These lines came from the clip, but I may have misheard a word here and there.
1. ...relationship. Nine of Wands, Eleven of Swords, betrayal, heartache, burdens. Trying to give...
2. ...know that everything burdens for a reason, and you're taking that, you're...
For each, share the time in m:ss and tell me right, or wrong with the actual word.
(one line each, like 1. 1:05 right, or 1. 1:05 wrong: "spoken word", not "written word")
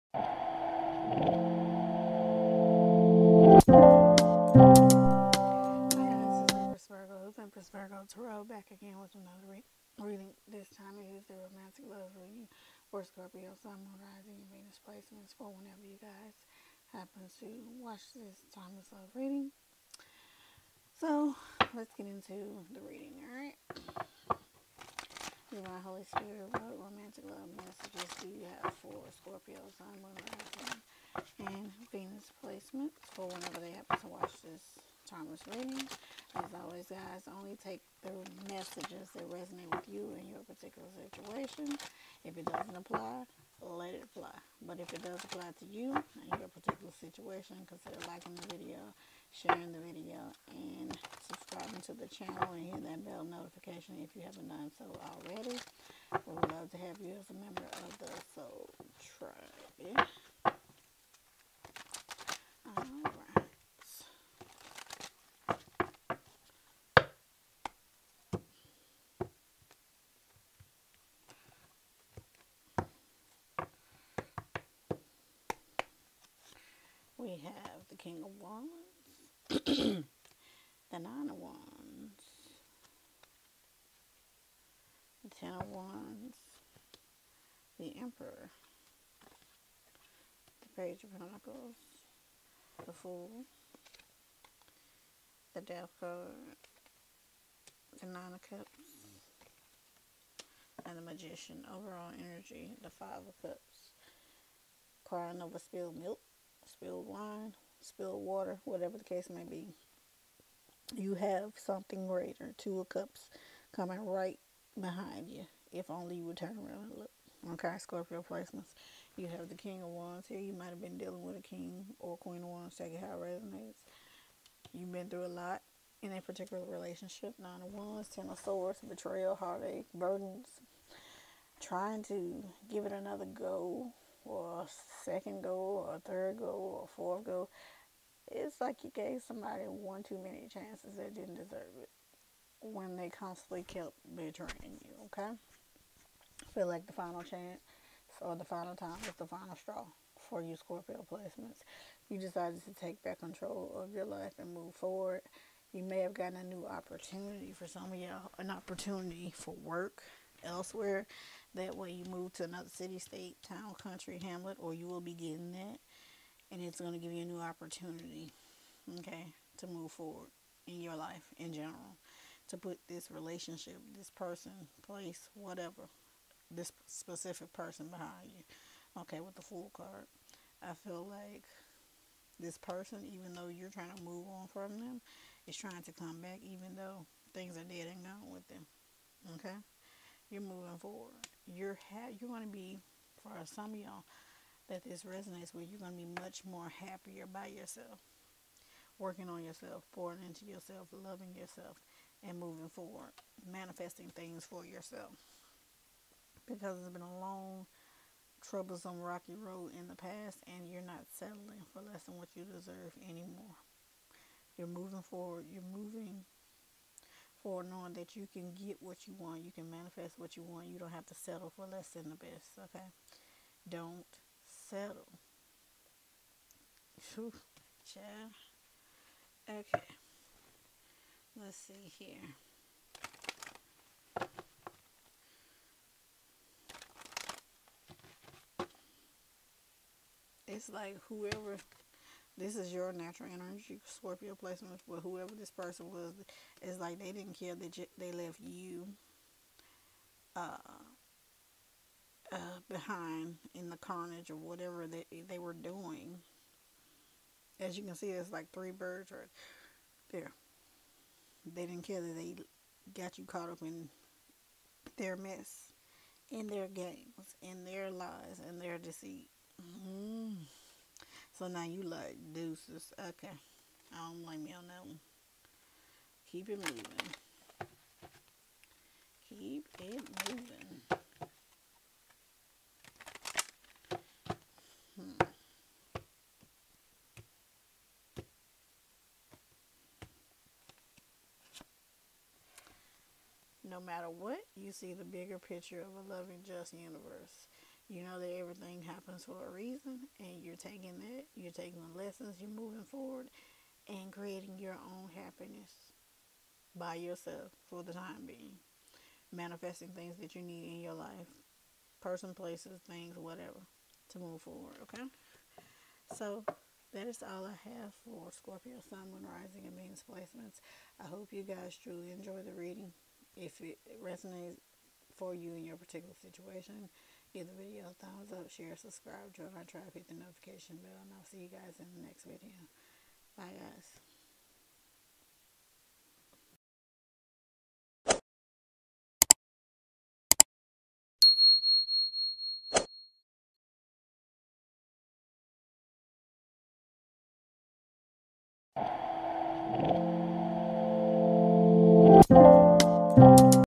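1. 2:06 wrong: "Ten", not "Eleven"
2. 4:58 wrong: "happens", not "burdens".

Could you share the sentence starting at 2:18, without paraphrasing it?
It's like you gave somebody one too many chances that didn't deserve it when they constantly kept betraying you, okay?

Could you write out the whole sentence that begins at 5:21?
I hope you guys truly enjoy the reading.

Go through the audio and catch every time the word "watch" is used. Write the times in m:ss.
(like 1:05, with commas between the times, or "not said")
0:17, 0:34.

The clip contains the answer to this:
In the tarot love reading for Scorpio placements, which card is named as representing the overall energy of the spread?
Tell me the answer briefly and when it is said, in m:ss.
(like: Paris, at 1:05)
Five of Cups, at 1:42.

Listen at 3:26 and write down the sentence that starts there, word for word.
Because it's been a long, troublesome, rocky road in the past, and you're not settling for less than what you deserve anymore.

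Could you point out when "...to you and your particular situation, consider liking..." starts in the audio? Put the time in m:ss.
0:45.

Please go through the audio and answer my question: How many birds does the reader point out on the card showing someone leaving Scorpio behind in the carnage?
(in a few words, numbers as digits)
3.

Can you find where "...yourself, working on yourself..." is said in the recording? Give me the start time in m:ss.
3:17.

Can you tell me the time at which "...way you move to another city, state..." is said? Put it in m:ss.
2:41.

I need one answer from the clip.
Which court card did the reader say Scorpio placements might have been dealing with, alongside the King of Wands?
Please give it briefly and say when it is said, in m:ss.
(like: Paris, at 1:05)
Queen of Wands, at 2:02.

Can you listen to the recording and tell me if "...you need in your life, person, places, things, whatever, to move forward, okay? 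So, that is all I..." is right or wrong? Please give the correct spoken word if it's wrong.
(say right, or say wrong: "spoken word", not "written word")
right.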